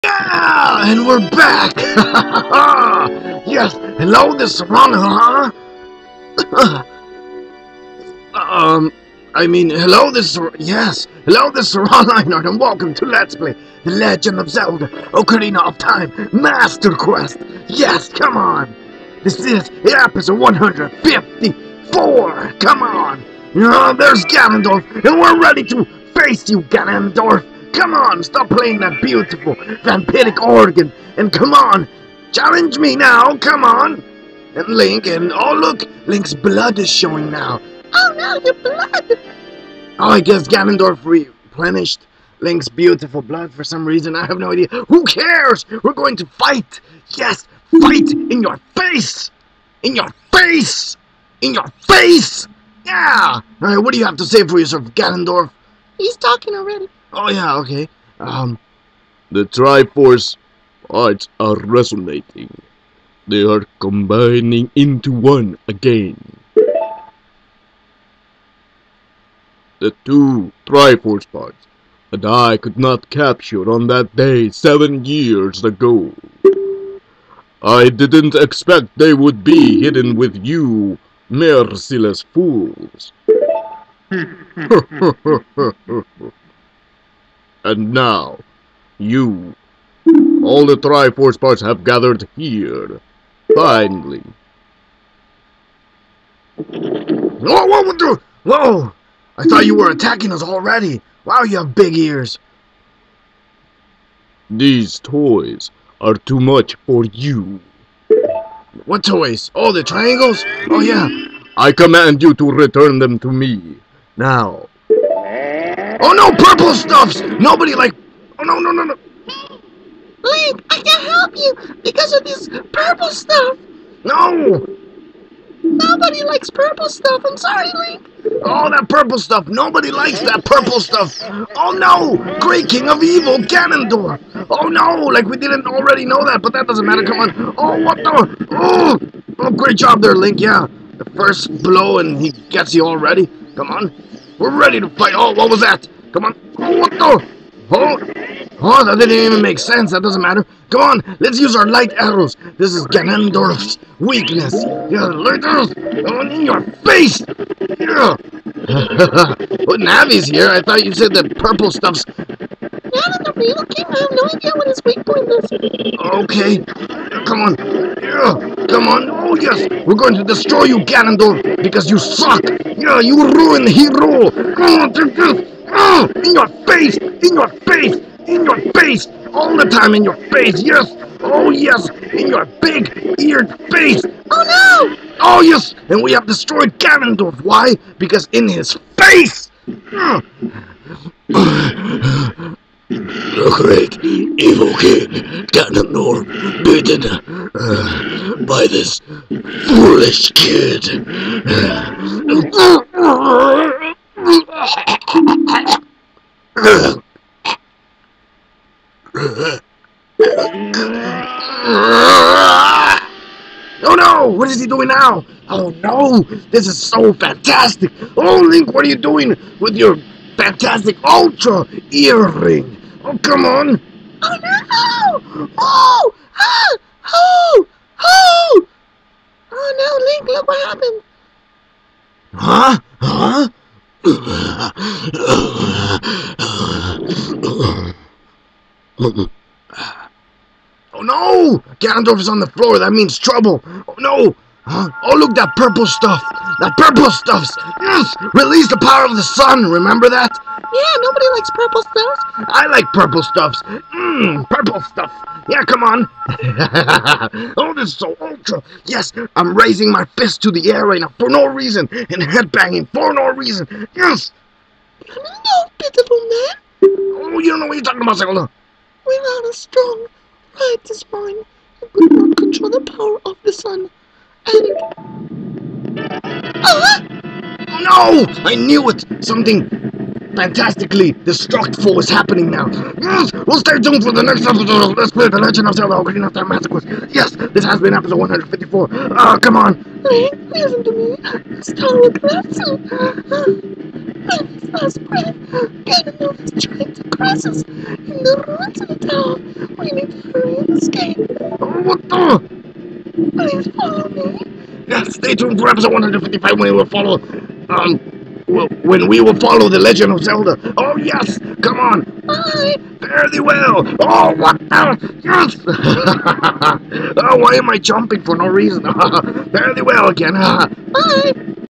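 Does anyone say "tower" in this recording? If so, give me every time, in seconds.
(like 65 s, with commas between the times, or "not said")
299 s.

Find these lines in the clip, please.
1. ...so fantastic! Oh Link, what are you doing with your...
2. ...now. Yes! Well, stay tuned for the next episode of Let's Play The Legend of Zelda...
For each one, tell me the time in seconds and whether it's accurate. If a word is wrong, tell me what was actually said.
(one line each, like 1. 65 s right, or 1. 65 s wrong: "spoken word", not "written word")
1. 216 s right
2. 282 s right.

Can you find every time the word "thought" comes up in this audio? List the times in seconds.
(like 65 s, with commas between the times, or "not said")
99 s, 160 s.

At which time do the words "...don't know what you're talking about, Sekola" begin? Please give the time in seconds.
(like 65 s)
267 s.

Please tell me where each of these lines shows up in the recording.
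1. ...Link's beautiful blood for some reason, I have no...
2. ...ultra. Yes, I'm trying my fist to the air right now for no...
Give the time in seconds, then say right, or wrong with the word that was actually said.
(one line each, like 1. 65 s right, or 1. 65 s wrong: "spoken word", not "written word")
1. 42 s right
2. 258 s wrong: "raising", not "trying".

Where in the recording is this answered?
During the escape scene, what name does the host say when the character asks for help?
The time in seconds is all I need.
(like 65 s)
294 s.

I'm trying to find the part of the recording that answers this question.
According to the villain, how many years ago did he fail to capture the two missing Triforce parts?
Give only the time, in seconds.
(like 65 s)
74 s.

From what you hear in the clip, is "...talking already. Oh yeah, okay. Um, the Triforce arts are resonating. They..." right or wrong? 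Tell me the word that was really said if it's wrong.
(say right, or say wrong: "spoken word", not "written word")
right.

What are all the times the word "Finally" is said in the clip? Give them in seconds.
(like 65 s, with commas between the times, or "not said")
93 s.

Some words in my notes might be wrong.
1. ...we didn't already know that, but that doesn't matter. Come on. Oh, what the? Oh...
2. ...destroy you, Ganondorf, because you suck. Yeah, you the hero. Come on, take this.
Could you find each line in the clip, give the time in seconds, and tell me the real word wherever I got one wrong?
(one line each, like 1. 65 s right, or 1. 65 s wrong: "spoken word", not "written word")
1. 135 s right
2. 170 s right.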